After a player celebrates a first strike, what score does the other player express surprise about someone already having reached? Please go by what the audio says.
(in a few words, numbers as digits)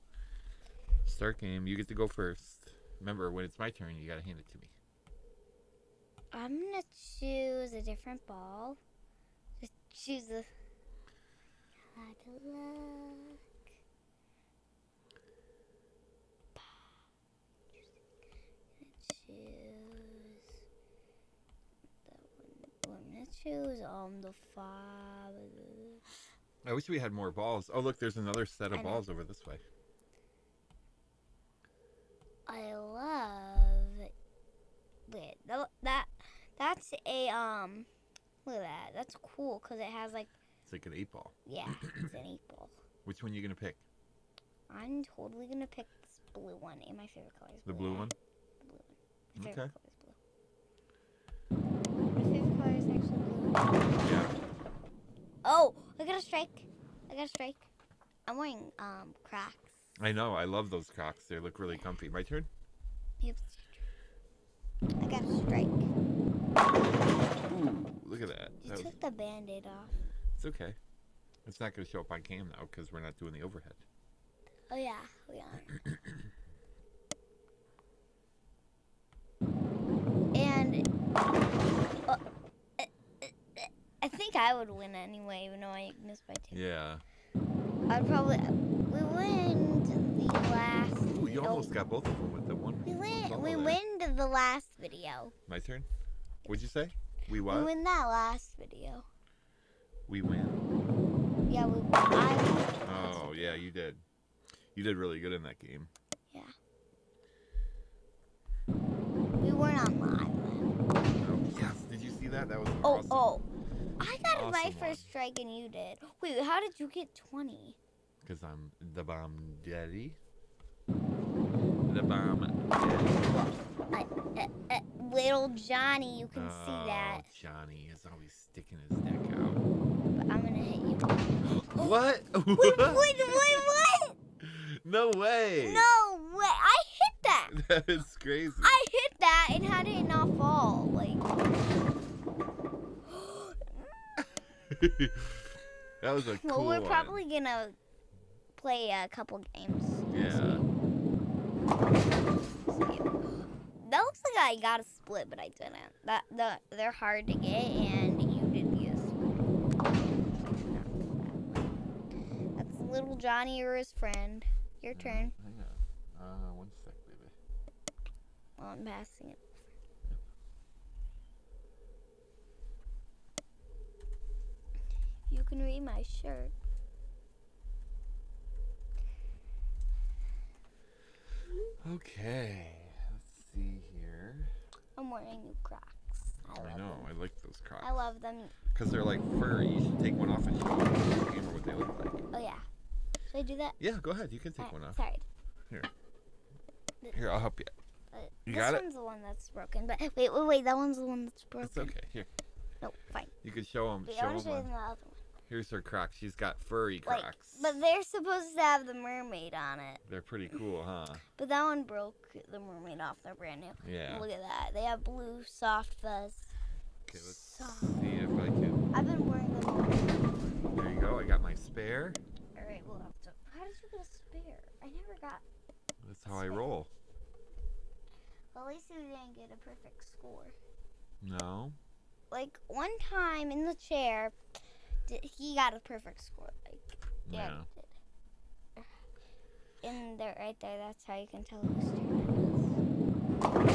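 20.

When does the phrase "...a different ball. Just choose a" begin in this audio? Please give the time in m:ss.
0:07.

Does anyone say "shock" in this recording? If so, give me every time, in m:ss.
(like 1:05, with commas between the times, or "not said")
not said.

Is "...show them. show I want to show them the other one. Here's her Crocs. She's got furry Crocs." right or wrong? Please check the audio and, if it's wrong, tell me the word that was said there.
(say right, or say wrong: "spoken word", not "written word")
right.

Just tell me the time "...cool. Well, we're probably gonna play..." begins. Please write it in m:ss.
2:26.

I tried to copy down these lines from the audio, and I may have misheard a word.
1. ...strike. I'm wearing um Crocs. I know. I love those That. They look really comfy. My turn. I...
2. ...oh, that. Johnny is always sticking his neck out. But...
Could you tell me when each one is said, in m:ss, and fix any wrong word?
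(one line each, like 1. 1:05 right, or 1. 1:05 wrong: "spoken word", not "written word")
1. 0:57 wrong: "Crocs", not "That"
2. 2:06 right.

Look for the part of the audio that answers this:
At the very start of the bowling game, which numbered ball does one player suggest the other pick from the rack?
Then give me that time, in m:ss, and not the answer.
0:24.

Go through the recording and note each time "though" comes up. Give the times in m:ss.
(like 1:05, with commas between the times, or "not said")
1:12, 1:25.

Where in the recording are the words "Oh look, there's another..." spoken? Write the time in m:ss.
0:27.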